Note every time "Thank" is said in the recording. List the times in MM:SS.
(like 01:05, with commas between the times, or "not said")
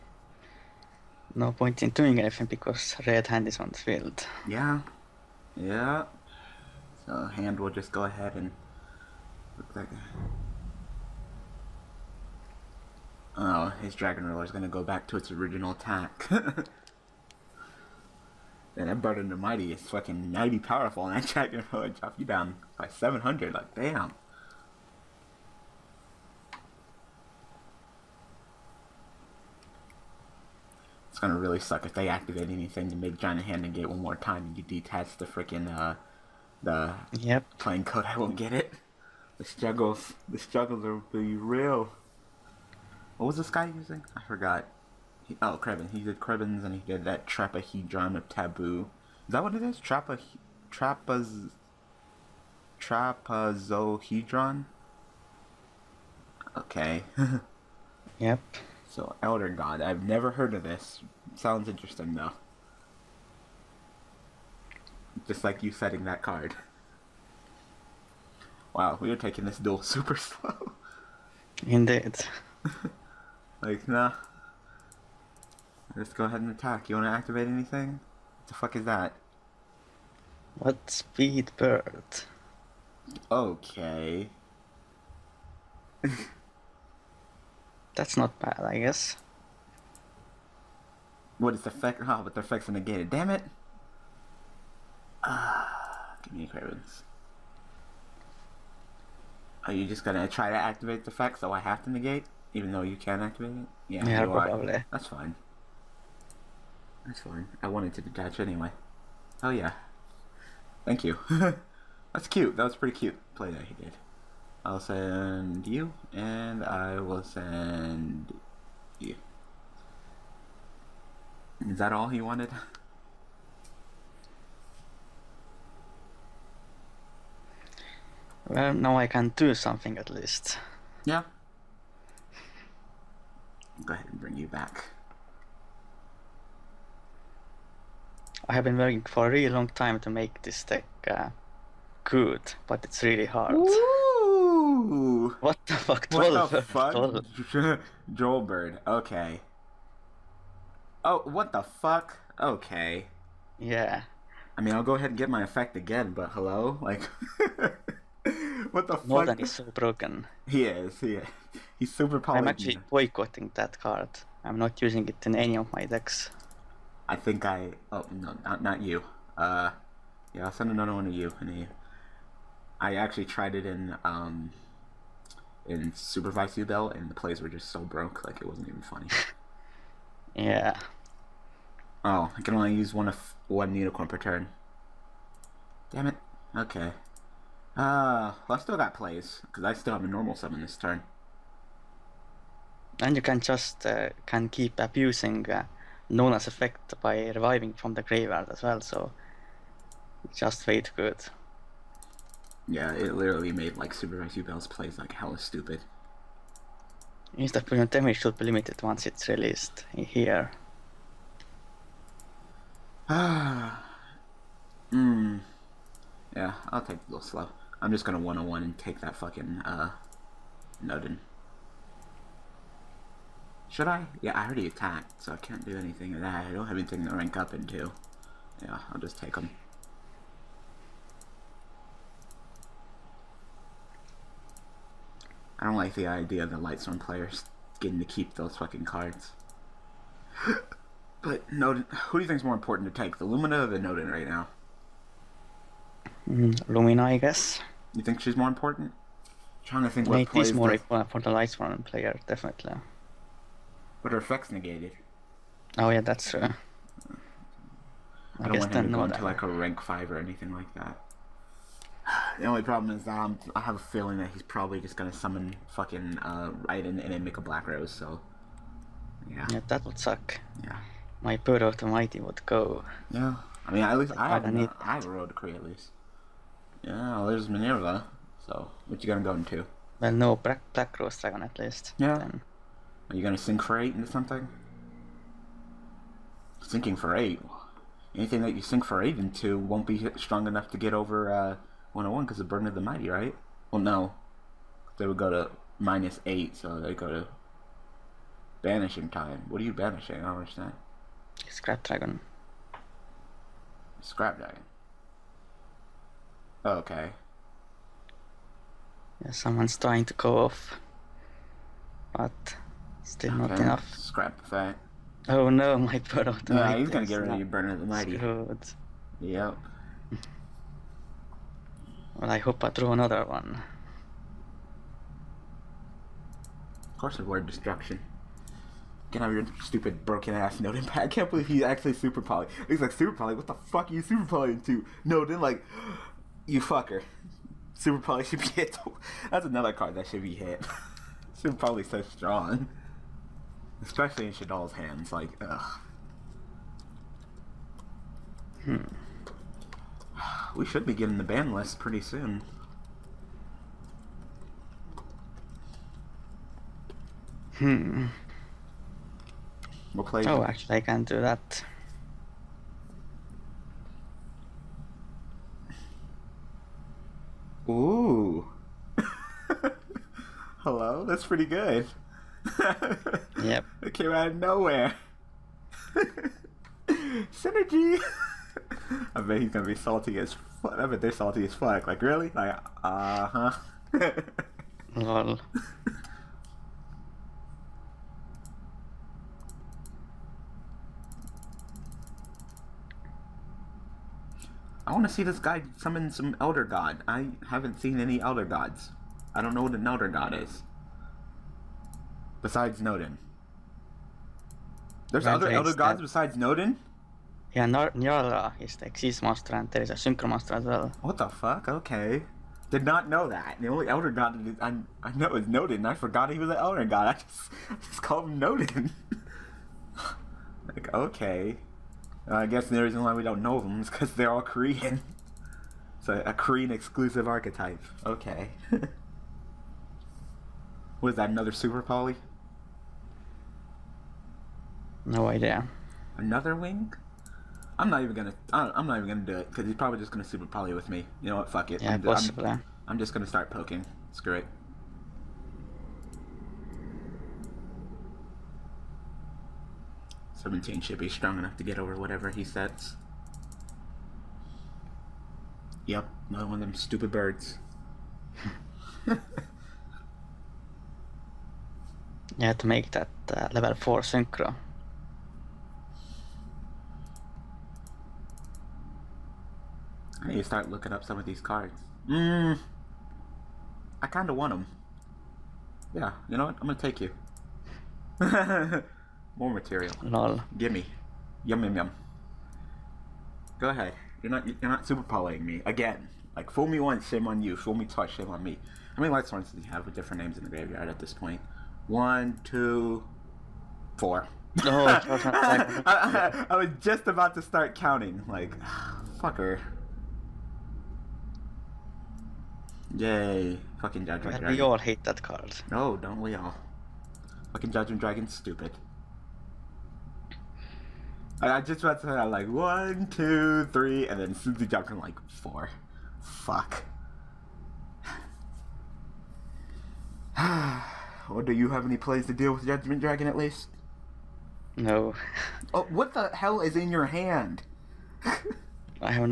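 01:50.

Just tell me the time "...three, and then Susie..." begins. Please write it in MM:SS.
08:33.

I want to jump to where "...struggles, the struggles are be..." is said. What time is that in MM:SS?
00:39.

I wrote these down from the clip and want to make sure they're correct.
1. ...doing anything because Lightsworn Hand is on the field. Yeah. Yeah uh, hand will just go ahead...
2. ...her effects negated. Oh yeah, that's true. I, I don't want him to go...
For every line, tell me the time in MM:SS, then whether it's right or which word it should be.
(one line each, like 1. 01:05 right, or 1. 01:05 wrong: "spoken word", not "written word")
1. 00:01 wrong: "Red", not "Lightsworn"
2. 04:14 right.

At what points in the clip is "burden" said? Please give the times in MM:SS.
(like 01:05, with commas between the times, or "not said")
00:19, 04:52, 05:17.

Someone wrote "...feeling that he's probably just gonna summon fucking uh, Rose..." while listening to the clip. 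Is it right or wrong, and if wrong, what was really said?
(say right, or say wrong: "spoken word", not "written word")
wrong: "Raiden", not "Rose".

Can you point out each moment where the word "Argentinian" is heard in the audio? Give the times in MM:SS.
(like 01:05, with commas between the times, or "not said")
not said.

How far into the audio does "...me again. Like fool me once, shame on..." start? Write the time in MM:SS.
08:05.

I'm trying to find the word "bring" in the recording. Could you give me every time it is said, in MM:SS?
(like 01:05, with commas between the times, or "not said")
02:14.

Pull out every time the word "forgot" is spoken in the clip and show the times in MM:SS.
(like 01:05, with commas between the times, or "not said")
00:44, 06:55.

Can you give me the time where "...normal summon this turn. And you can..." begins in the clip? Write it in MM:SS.
03:10.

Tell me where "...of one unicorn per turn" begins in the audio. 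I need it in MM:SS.
03:03.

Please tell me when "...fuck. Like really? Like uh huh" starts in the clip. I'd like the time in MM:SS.
06:21.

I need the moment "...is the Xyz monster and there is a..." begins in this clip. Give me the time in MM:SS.
06:48.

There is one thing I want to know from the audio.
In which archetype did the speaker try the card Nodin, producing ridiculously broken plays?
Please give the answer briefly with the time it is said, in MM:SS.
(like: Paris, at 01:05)
Yubel, at 02:55.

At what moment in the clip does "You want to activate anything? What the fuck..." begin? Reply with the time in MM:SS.
01:16.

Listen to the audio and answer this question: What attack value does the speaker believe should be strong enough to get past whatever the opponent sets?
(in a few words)
17.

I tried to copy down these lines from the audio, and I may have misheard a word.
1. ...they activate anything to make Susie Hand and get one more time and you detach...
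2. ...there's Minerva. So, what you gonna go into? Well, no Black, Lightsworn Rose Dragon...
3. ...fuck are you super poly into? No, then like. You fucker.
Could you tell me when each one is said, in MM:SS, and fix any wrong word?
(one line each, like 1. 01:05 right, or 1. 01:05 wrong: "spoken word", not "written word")
1. 00:31 wrong: "Giant", not "Susie"
2. 04:37 wrong: "Black", not "Lightsworn"
3. 05:33 right.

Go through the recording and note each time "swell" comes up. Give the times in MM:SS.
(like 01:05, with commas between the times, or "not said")
not said.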